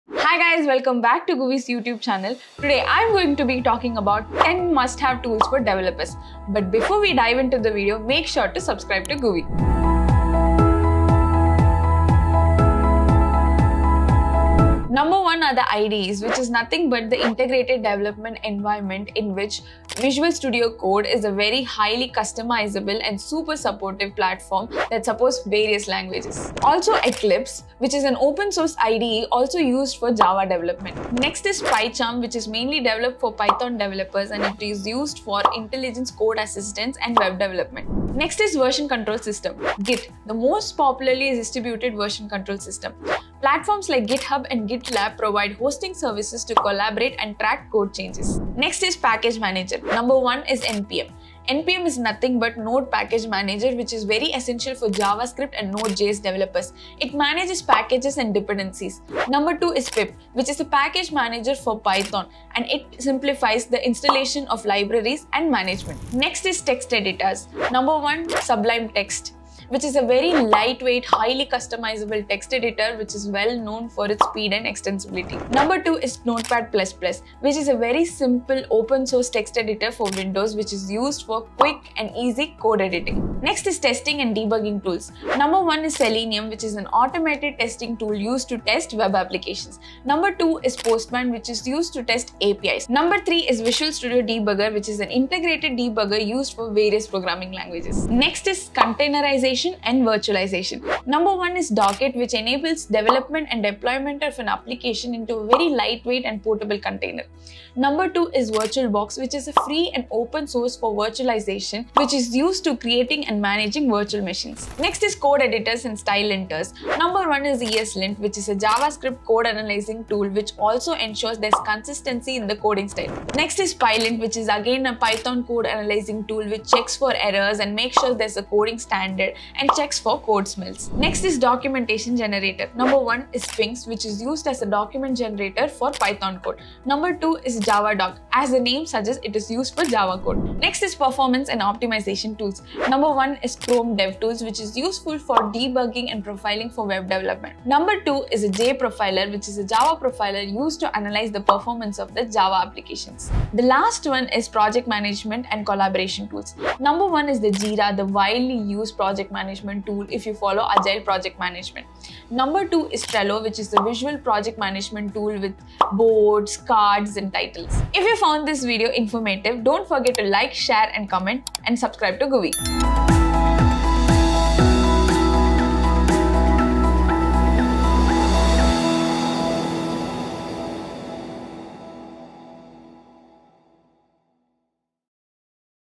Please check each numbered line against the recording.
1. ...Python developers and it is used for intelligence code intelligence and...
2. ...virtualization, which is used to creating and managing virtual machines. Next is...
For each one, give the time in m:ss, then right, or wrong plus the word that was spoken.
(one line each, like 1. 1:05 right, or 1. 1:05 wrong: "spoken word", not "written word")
1. 0:33 wrong: "assistance", not "intelligence"
2. 1:50 right.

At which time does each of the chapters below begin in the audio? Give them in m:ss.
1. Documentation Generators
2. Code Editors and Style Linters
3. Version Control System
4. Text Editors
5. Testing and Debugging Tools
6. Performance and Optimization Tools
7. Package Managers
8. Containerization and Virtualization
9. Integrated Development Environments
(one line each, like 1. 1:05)
1. 2:11
2. 1:56
3. 0:39
4. 1:07
5. 1:23
6. 2:21
7. 0:49
8. 1:39
9. 0:13.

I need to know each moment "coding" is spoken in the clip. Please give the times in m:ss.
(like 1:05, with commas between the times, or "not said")
2:02, 2:08.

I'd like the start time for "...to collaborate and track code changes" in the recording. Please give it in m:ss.
0:46.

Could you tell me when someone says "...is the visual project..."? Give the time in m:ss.
2:43.